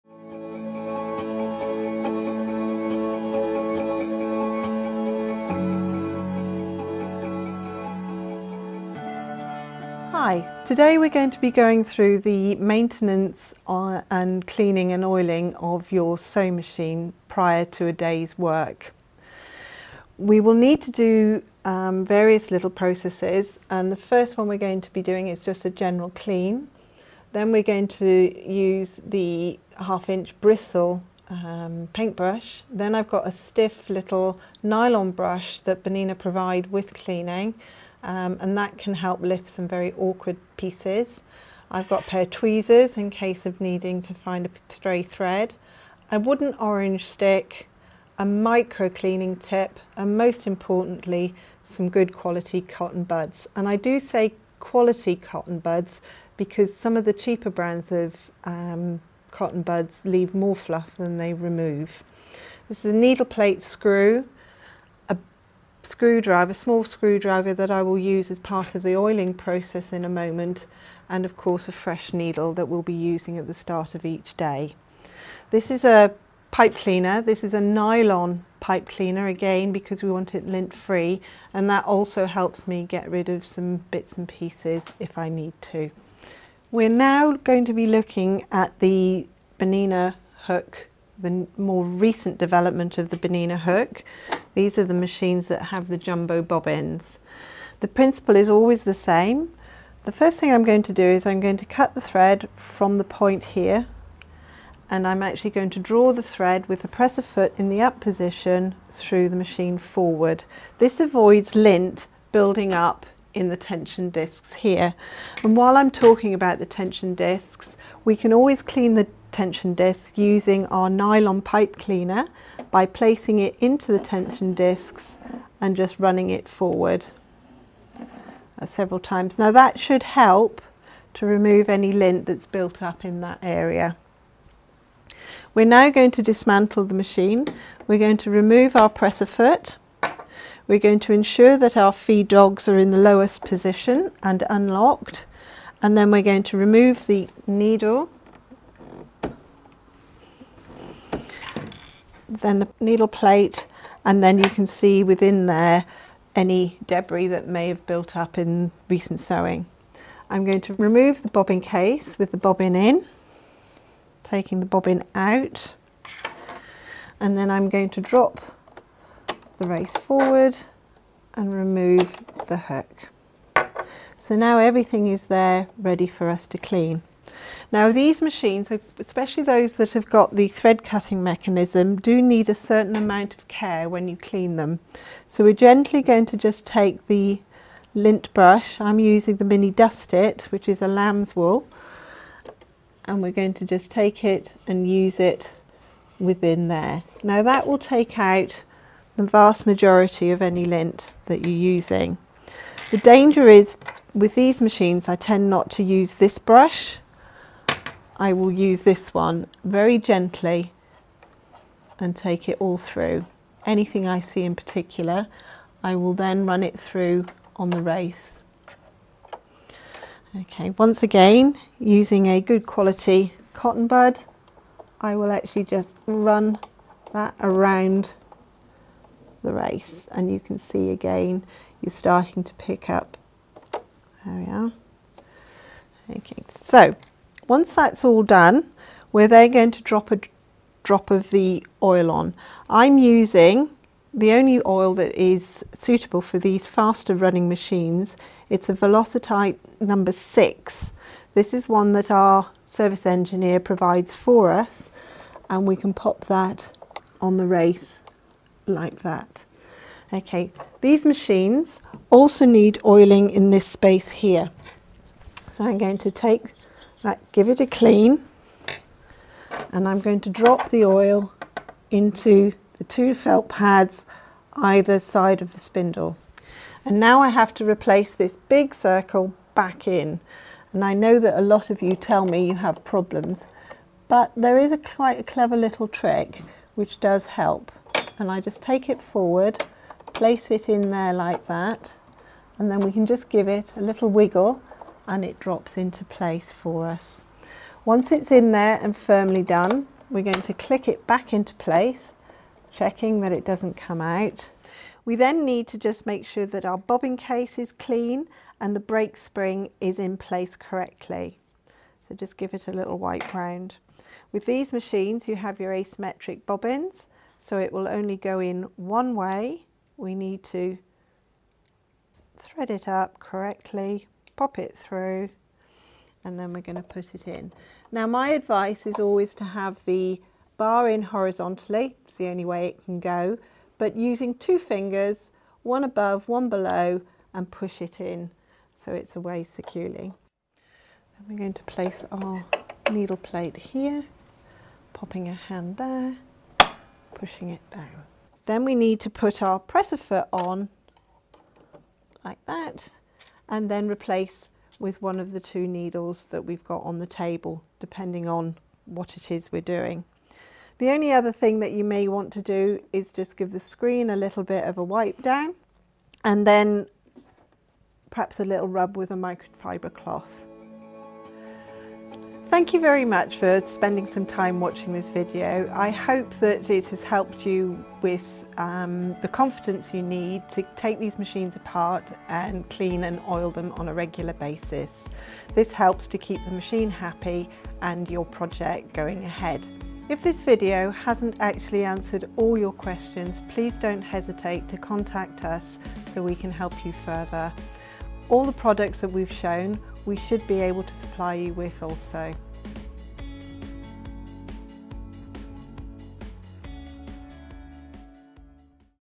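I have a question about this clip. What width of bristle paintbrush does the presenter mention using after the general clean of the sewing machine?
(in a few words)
half inch.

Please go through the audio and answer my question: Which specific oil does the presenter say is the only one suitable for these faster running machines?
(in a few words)
Velocite number 6.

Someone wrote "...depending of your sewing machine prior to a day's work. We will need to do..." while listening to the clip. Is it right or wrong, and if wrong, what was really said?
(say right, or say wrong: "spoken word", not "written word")
wrong: "oiling", not "depending".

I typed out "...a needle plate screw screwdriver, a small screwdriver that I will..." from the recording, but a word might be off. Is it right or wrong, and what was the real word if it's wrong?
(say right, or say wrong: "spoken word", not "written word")
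right.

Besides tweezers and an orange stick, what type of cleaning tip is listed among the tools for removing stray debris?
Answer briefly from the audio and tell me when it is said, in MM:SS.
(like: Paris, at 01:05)
micro cleaning tip, at 00:48.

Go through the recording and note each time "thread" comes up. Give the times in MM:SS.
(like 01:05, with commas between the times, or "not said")
00:45, 01:42, 01:46, 03:00, 05:22.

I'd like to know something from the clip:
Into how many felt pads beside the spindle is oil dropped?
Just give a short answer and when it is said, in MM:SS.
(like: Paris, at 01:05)
2, at 04:32.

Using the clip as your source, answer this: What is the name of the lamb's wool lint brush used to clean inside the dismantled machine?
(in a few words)
mini dust it.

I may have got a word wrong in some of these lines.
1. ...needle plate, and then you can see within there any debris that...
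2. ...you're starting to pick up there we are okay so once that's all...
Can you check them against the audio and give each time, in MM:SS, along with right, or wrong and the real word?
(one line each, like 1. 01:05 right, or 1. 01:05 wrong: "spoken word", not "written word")
1. 02:32 right
2. 03:51 right.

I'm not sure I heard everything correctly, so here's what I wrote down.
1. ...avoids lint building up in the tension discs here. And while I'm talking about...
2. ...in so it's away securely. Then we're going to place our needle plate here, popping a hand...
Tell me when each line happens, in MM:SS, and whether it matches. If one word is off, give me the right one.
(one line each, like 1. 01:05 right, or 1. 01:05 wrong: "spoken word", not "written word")
1. 01:50 right
2. 05:38 right.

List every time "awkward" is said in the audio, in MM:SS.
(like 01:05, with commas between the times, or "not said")
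00:39.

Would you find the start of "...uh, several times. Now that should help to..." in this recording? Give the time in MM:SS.
02:07.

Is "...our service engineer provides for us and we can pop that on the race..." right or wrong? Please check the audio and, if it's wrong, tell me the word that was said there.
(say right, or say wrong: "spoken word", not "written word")
right.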